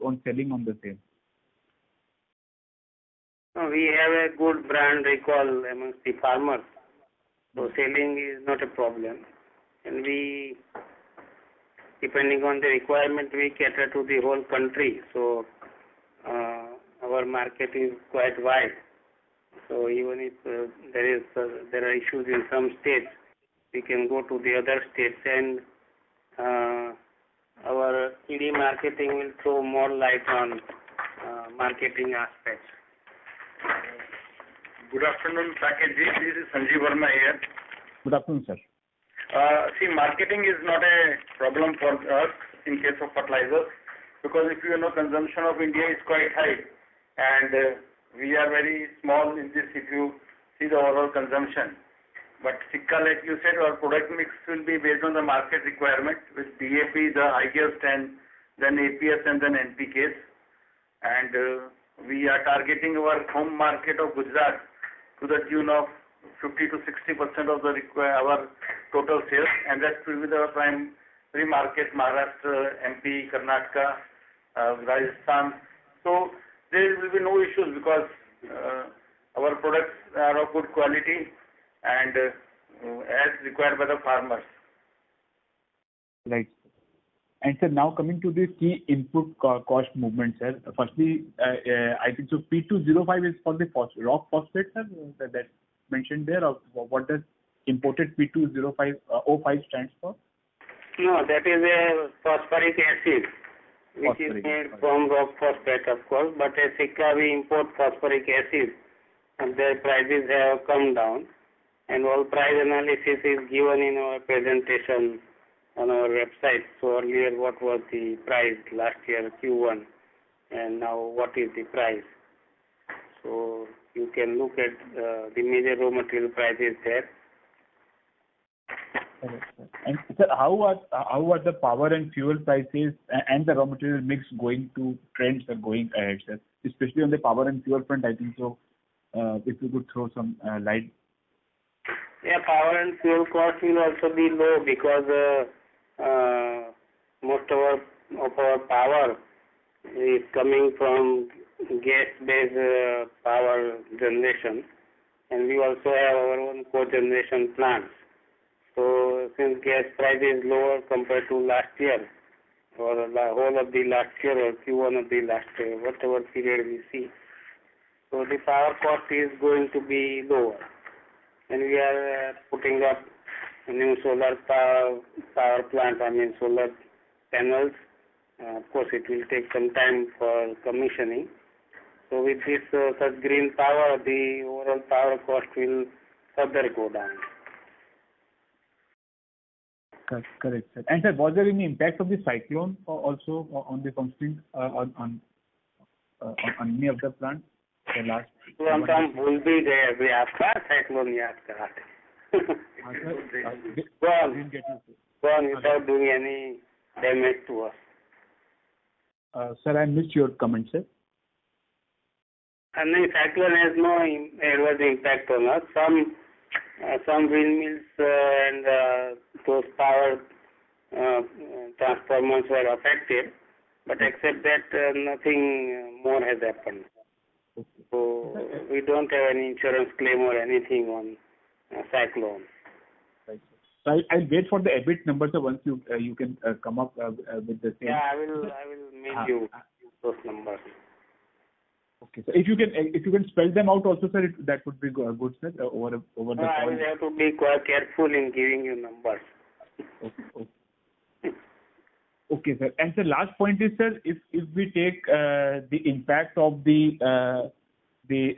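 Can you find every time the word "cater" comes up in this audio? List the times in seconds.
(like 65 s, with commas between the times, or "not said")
13 s.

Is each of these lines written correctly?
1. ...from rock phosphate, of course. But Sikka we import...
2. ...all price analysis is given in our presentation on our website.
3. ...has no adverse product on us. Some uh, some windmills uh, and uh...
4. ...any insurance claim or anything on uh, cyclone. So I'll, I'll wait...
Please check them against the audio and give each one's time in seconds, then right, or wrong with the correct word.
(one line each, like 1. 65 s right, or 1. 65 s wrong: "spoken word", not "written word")
1. 104 s right
2. 112 s right
3. 213 s wrong: "impact", not "product"
4. 229 s right.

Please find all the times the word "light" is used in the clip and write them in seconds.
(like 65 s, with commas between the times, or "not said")
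29 s, 140 s.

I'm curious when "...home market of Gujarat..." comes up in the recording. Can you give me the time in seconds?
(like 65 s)
63 s.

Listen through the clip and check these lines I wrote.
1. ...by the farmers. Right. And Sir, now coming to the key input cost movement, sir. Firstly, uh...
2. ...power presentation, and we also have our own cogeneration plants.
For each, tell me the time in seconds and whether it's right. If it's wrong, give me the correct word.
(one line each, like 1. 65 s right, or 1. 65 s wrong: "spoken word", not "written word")
1. 83 s right
2. 153 s wrong: "generation", not "presentation".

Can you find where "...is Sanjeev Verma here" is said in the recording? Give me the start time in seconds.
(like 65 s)
36 s.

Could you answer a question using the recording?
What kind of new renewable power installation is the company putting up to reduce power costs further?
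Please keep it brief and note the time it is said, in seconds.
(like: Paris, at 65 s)
Solar panels, at 176 s.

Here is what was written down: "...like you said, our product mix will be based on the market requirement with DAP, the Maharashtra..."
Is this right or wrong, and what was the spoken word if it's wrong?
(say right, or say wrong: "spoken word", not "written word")
wrong: "IGF", not "Maharashtra".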